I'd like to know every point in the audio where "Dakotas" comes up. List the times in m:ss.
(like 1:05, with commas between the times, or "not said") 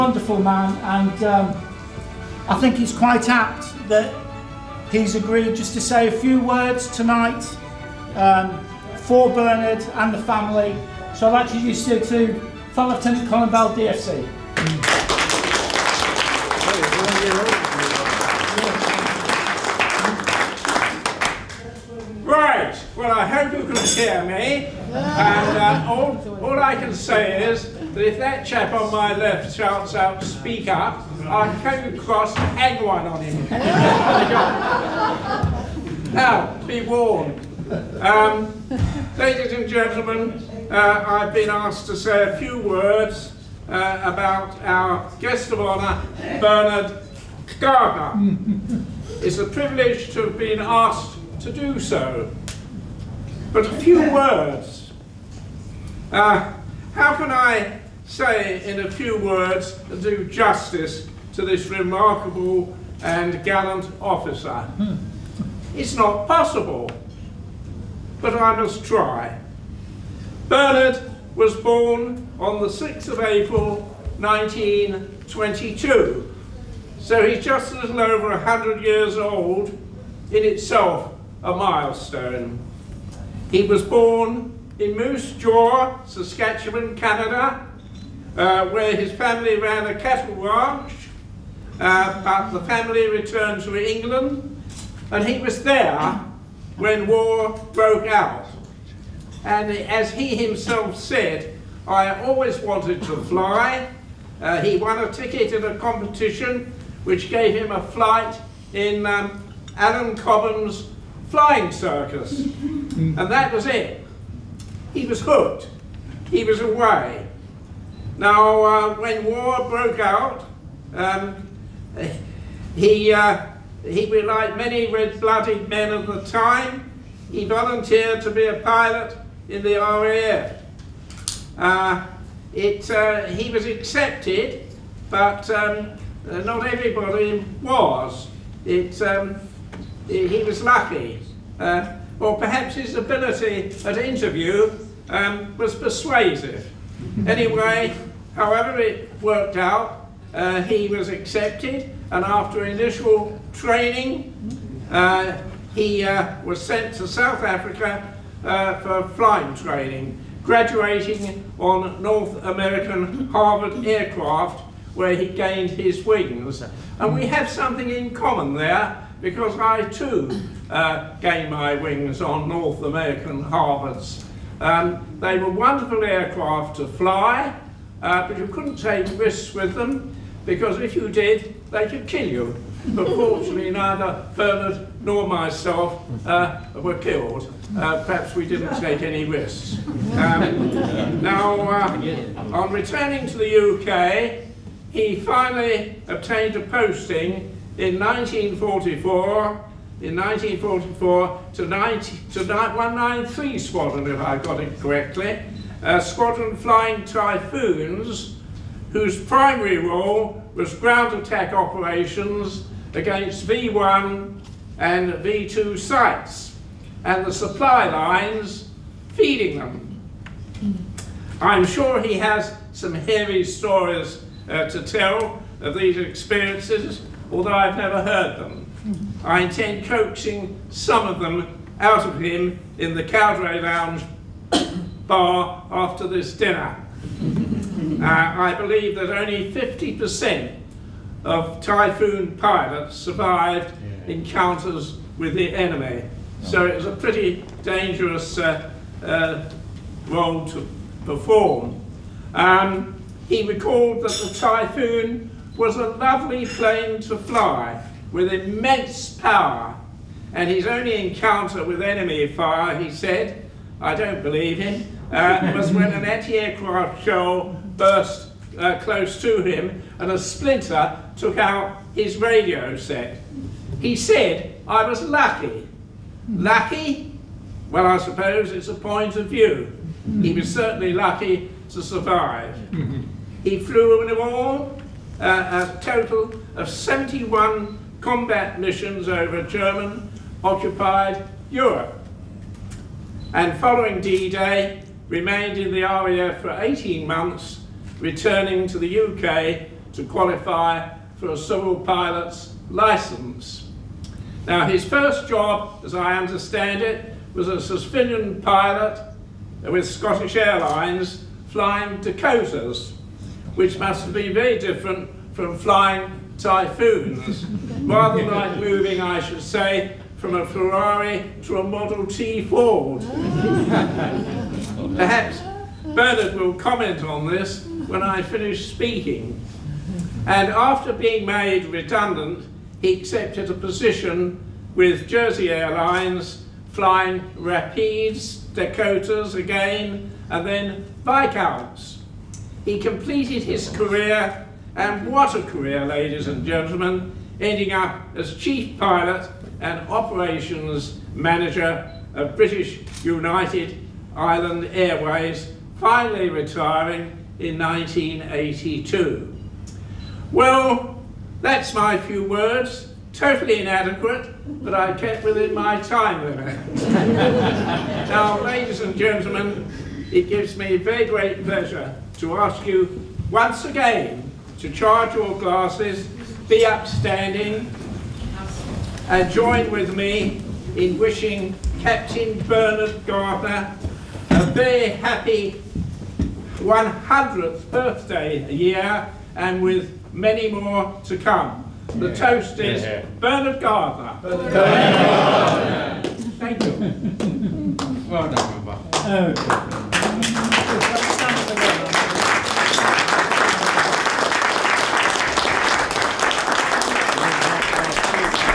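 5:11, 5:38.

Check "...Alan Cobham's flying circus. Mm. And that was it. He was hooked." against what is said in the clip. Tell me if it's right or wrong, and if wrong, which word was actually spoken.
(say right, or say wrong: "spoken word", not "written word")
right.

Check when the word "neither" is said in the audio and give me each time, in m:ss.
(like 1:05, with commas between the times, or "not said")
3:03.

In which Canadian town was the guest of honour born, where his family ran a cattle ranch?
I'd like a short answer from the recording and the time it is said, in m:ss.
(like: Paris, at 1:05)
Moose Jaw, at 1:24.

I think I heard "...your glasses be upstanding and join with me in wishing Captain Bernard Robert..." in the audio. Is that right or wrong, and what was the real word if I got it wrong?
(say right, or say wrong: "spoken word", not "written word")
wrong: "Gardiner", not "Robert".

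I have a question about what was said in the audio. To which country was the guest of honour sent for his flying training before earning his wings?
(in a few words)
South Africa.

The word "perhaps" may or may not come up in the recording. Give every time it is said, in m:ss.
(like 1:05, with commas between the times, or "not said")
2:22, 3:08, 5:24.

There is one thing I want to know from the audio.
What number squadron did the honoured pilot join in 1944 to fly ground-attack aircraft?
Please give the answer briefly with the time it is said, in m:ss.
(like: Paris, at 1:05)
193, at 3:22.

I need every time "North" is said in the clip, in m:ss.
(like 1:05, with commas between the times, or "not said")
2:42, 2:52.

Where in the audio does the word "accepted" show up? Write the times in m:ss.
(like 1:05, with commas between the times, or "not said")
2:13, 2:31, 5:32.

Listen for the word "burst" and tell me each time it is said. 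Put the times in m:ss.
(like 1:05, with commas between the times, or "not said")
4:27.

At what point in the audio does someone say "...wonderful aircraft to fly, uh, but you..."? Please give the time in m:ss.
2:55.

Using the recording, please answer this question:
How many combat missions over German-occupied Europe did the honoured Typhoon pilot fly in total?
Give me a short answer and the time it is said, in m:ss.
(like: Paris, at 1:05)
71, at 4:46.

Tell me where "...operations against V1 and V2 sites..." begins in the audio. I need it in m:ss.
3:31.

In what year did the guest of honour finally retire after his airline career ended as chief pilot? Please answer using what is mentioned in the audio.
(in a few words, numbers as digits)
1982.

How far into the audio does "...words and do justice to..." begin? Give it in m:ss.
0:59.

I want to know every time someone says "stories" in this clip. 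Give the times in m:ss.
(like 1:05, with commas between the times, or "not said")
3:43.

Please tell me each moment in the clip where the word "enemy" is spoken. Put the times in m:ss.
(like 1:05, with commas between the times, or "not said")
4:05, 4:21.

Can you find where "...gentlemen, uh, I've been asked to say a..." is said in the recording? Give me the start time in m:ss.
0:39.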